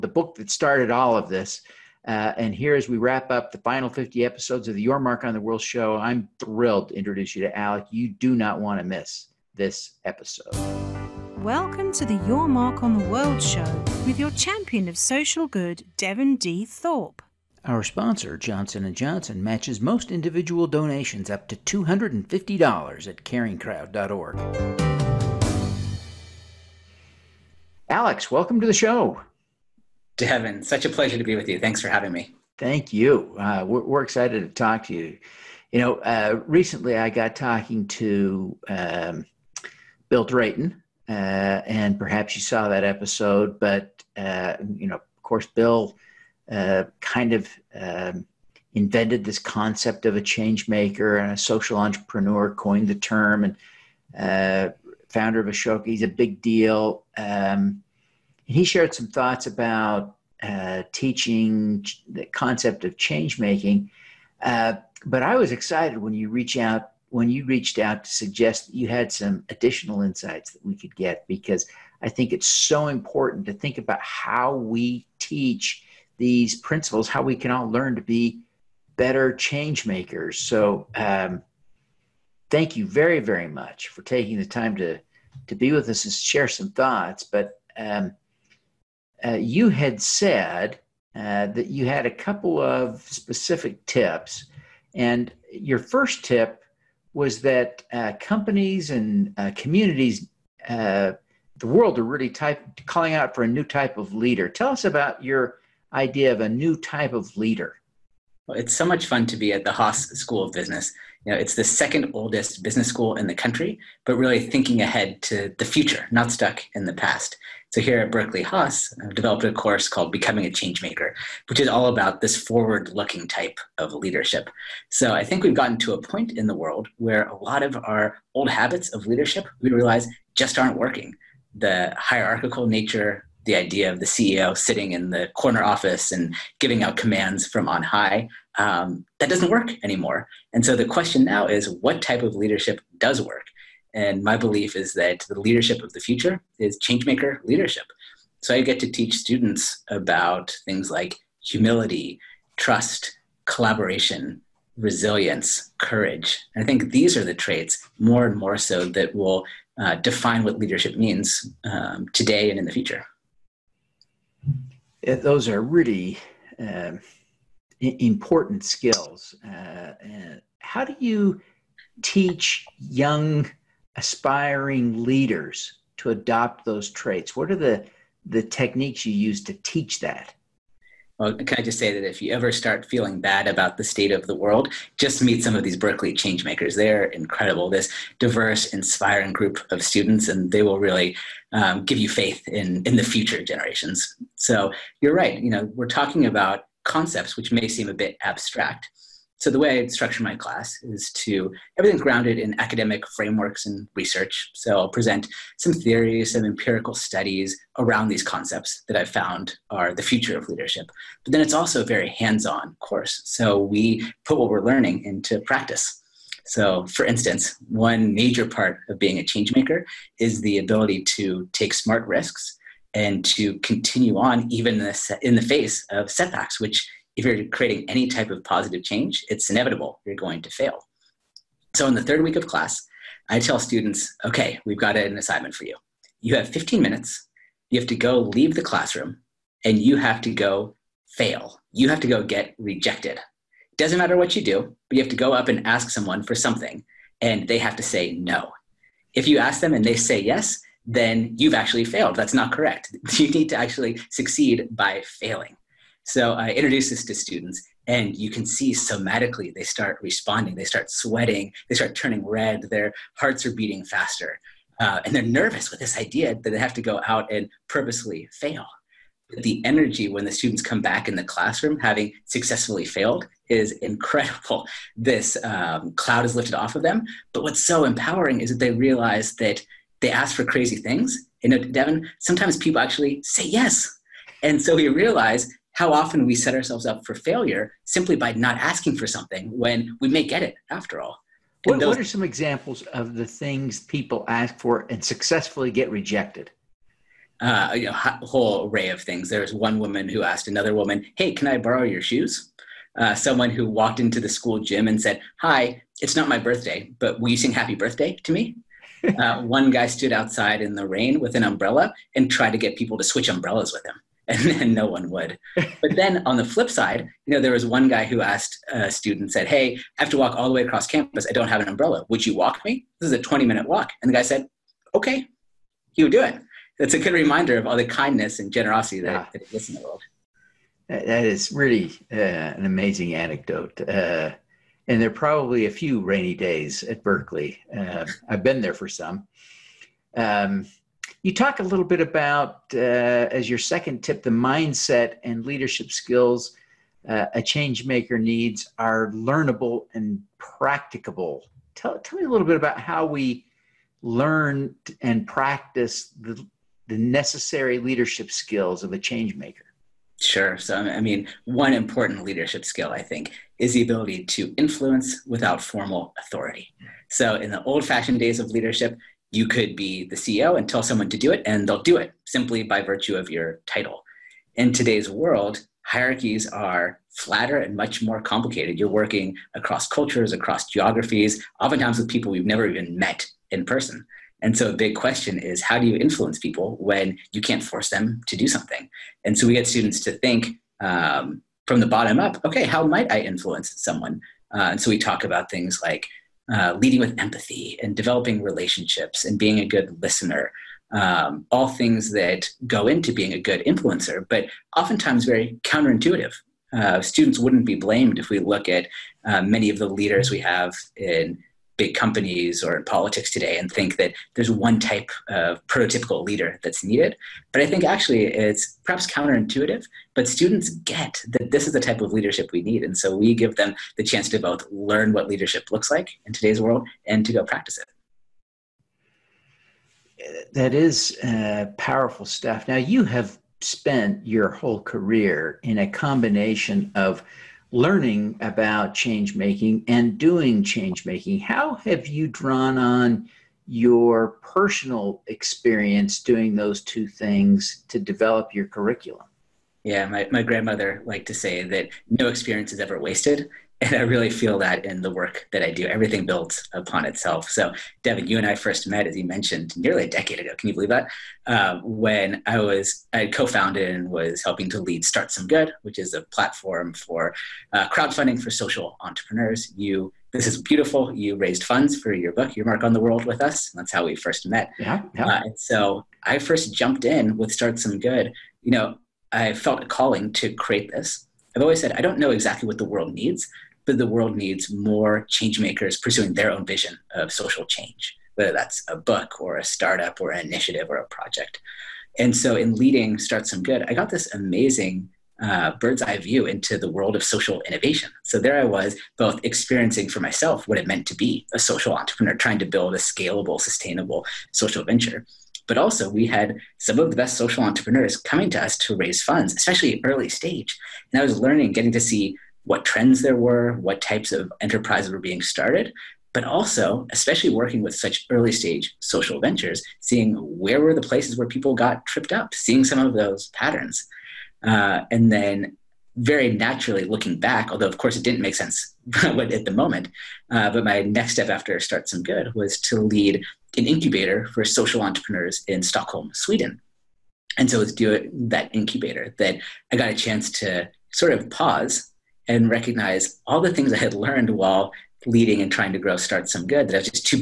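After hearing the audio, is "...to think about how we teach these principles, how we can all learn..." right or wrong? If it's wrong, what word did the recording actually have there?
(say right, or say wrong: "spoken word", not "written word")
right.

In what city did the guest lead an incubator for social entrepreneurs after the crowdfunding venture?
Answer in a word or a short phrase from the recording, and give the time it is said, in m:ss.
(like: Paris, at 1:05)
Stockholm, at 8:55.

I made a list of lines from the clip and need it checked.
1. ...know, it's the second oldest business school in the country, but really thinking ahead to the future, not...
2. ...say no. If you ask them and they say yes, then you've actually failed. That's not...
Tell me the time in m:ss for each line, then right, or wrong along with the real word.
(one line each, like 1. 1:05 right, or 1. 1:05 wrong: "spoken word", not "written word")
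1. 1:51 right
2. 4:07 right.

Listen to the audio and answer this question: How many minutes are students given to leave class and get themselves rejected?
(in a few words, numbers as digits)
15.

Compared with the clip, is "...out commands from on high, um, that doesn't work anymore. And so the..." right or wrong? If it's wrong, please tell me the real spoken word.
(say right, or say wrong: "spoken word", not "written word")
right.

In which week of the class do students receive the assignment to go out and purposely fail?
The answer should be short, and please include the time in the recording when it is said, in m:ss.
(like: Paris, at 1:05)
third week, at 3:52.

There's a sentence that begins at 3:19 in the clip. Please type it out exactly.
So the way I structure my class is to everything's grounded in academic frameworks and research.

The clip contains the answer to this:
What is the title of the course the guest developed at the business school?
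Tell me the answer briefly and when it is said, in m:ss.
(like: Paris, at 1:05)
Becoming a Changemaker, at 2:00.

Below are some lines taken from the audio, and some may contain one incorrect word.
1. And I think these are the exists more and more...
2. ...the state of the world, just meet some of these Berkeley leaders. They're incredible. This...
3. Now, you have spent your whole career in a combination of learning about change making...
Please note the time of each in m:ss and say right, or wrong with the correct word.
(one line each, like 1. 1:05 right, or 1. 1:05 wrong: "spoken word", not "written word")
1. 2:36 wrong: "traits", not "exists"
2. 3:03 wrong: "changemakers", not "leaders"
3. 7:12 right.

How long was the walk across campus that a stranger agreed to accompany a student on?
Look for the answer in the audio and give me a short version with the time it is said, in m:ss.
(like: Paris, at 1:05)
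20 minutes, at 5:23.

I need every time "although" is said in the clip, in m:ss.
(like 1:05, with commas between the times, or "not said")
8:47.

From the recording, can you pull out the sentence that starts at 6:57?
But I think actually it's perhaps counterintuitive, but students get that this is the type of leadership we need.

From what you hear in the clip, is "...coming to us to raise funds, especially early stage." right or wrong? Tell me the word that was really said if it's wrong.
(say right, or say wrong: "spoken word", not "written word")
right.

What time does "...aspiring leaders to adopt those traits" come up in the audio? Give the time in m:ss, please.
2:53.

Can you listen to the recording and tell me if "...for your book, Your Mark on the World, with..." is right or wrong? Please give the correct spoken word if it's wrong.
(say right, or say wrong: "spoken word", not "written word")
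right.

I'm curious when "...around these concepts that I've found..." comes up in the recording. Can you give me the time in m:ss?
3:27.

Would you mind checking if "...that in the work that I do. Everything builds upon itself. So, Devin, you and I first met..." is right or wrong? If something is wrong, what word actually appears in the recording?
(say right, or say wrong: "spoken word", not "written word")
right.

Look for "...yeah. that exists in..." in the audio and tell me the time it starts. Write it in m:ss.
5:29.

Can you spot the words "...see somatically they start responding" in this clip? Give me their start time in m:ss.
4:18.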